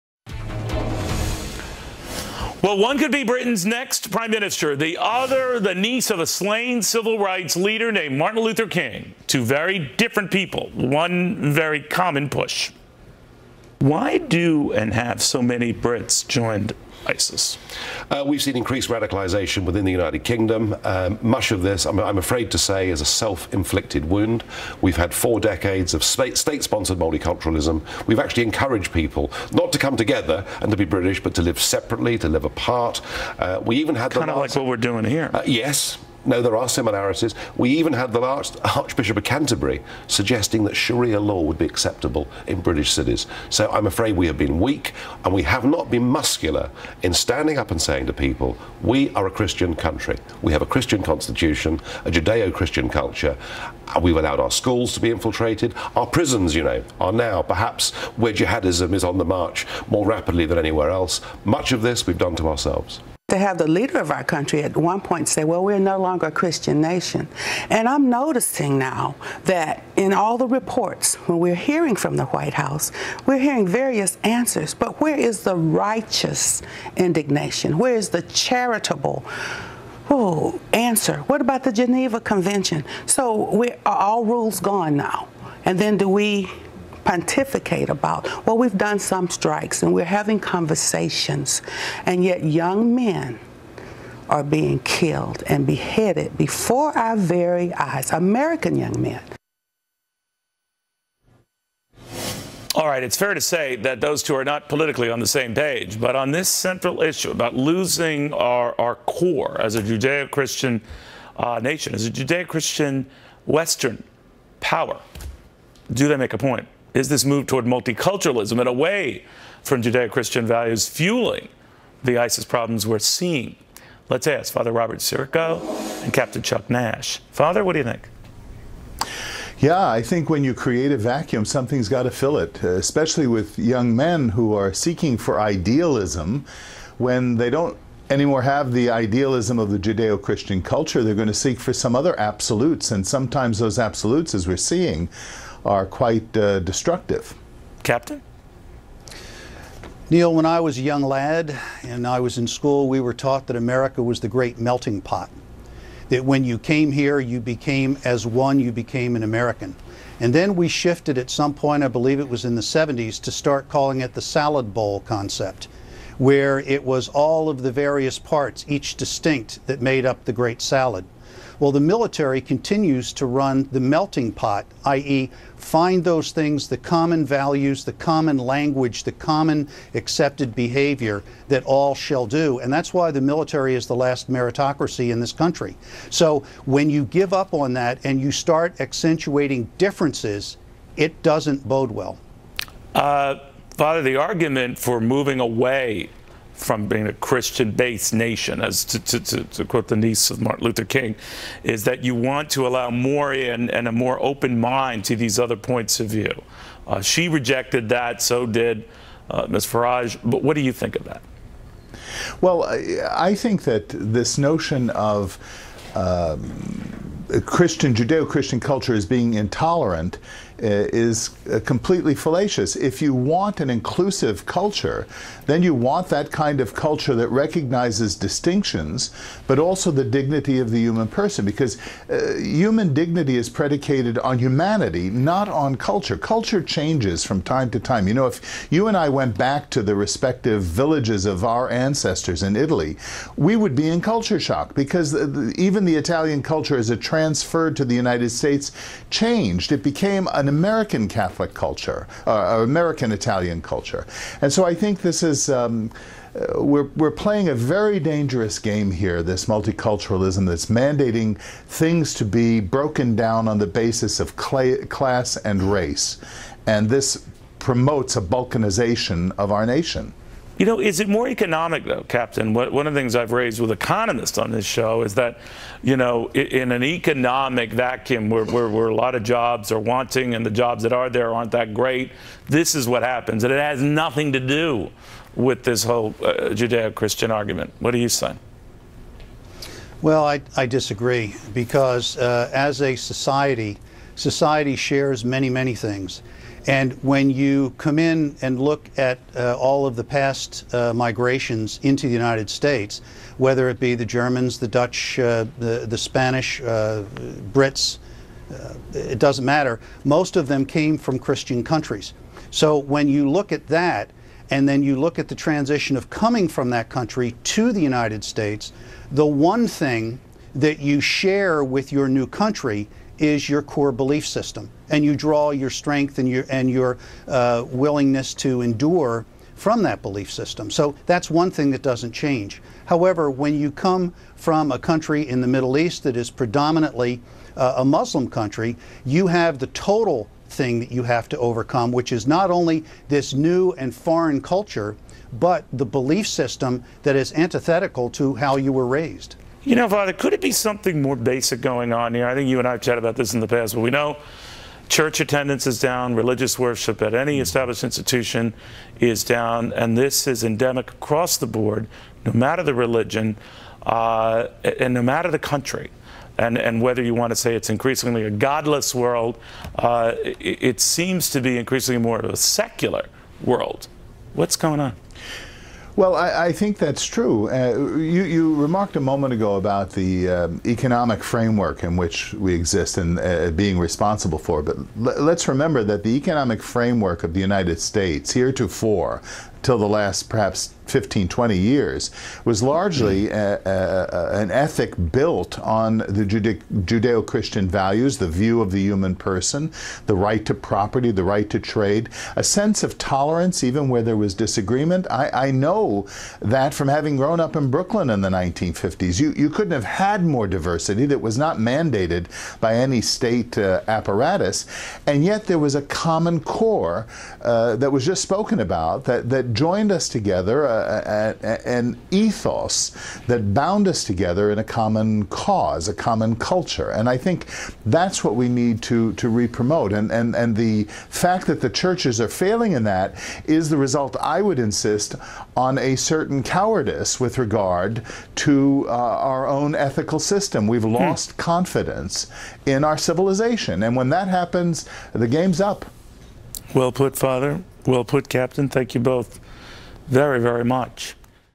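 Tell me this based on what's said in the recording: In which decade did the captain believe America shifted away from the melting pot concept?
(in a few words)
the 70s.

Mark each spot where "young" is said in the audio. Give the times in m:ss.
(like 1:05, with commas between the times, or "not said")
1:32, 1:38, 2:13, 2:30.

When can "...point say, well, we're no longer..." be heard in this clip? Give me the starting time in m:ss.
1:04.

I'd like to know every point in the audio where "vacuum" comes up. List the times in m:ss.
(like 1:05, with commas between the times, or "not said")
2:10, 4:37.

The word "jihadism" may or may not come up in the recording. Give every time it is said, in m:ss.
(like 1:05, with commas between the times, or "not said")
0:58.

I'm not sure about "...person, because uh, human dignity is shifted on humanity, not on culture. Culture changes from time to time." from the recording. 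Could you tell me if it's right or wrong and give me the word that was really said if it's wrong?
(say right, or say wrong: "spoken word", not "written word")
wrong: "predicated", not "shifted".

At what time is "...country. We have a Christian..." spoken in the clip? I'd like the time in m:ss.
0:49.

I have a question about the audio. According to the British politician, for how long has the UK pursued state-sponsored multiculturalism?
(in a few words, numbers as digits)
four decades.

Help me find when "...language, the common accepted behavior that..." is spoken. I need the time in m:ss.
2:58.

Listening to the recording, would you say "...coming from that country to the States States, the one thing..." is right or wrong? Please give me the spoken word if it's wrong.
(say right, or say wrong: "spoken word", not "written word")
wrong: "United", not "States".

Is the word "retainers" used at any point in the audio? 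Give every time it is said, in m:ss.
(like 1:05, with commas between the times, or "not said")
not said.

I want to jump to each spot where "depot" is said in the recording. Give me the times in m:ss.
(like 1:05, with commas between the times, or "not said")
not said.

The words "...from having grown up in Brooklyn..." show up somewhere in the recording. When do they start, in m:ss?
6:46.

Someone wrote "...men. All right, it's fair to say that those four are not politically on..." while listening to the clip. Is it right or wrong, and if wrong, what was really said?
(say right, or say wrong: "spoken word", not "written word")
wrong: "two", not "four".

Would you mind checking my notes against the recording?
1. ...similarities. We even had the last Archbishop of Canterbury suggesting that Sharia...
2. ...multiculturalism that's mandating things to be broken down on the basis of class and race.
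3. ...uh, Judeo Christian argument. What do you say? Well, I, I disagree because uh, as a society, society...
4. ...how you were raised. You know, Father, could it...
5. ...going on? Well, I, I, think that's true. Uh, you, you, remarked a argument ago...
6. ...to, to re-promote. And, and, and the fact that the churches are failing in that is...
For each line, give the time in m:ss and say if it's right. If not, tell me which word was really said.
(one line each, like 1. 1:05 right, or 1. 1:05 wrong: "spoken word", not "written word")
1. 0:36 right
2. 4:19 right
3. 4:46 right
4. 5:48 right
5. 6:14 wrong: "moment", not "argument"
6. 7:08 right.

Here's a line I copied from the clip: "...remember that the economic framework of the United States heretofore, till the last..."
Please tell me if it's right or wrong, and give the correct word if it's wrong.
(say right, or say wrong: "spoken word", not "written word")
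right.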